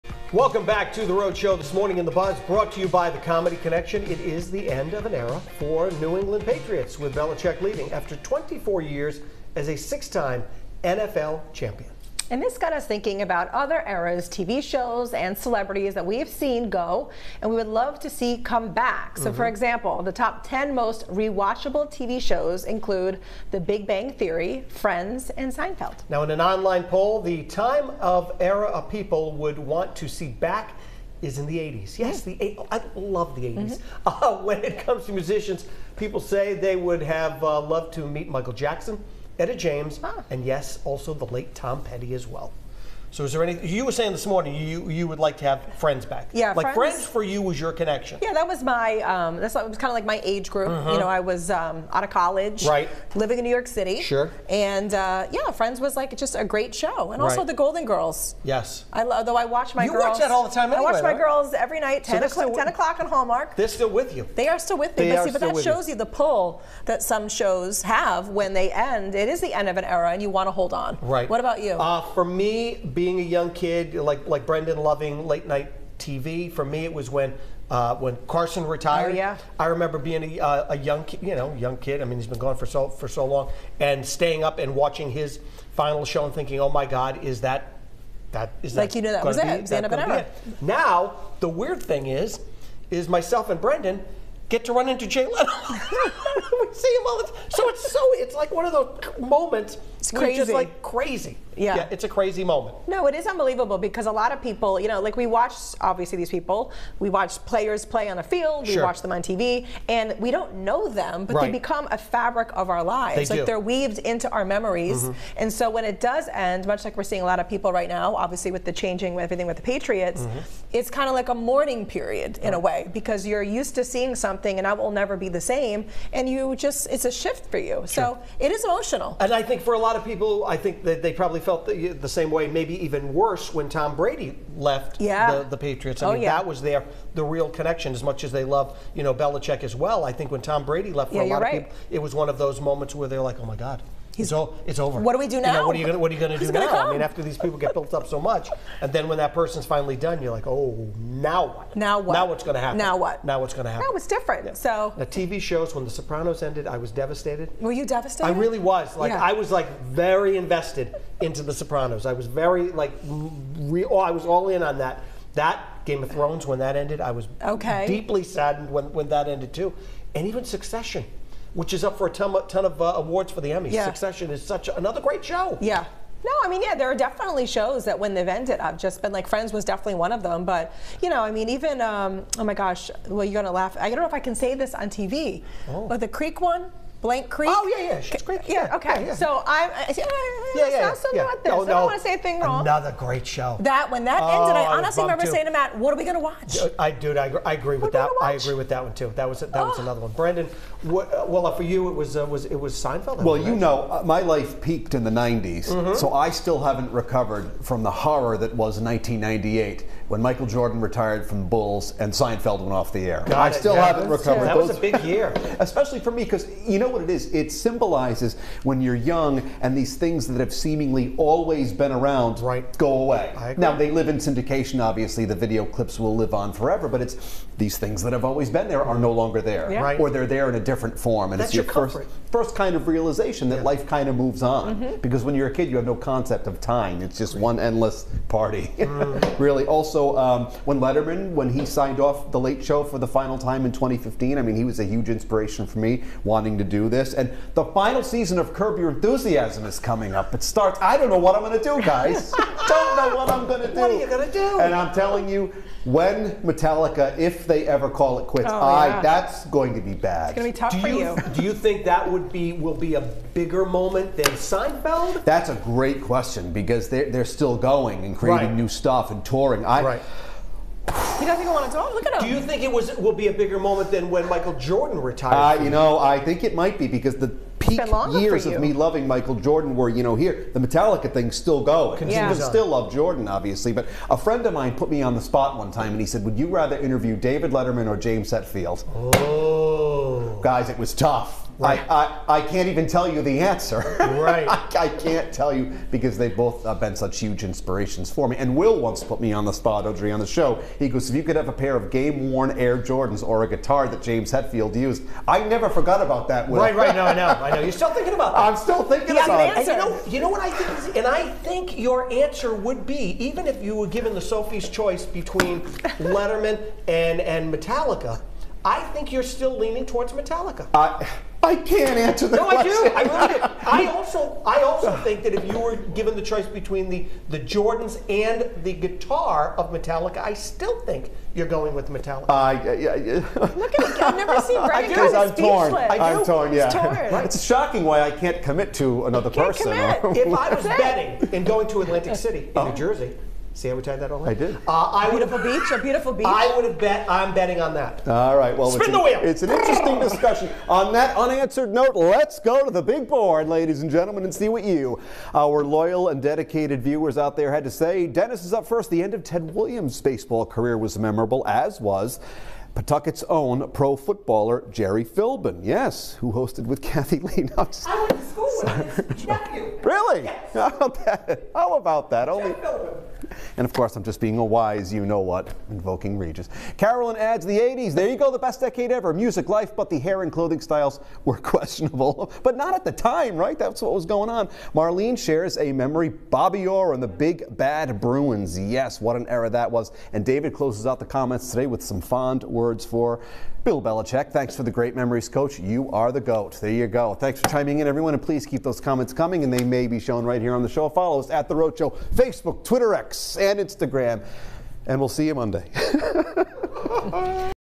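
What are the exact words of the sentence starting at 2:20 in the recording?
I think when Tom Brady left, for yeah, a lot right.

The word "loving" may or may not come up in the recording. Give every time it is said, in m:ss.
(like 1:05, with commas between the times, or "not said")
1:14, 4:38.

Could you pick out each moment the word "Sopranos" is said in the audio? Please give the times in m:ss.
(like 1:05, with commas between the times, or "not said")
2:35, 2:41.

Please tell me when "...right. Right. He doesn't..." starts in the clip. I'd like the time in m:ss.
4:29.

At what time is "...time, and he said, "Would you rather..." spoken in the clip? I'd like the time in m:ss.
4:45.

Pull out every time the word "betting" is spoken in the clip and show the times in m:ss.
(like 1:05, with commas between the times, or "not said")
5:40, 5:47.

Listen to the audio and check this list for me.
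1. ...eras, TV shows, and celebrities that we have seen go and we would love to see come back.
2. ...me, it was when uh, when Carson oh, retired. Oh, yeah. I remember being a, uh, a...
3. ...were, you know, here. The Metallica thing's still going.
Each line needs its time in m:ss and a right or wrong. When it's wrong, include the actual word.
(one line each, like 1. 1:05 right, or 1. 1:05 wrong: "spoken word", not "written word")
1. 0:13 right
2. 1:16 right
3. 4:39 right.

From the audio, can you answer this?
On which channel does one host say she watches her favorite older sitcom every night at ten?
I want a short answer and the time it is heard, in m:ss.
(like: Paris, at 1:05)
Hallmark, at 1:03.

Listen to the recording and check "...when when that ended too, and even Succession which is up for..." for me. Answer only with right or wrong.
right.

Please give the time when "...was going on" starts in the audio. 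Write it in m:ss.
6:23.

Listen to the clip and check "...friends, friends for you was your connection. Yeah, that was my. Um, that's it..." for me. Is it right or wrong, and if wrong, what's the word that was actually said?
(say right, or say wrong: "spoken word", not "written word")
right.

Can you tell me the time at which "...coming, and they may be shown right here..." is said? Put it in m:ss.
6:39.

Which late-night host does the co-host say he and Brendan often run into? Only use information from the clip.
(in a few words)
Jay Leno.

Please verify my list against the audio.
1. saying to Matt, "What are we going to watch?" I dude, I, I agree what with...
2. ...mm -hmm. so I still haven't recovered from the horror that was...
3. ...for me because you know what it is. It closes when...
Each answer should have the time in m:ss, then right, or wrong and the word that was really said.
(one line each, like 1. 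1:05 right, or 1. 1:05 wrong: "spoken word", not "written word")
1. 3:15 right
2. 3:25 right
3. 3:36 wrong: "symbolizes", not "closes".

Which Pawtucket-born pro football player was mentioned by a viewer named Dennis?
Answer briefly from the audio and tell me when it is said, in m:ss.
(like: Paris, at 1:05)
Jerry Philbin, at 6:04.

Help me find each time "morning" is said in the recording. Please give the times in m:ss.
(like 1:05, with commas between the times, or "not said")
0:01, 0:44.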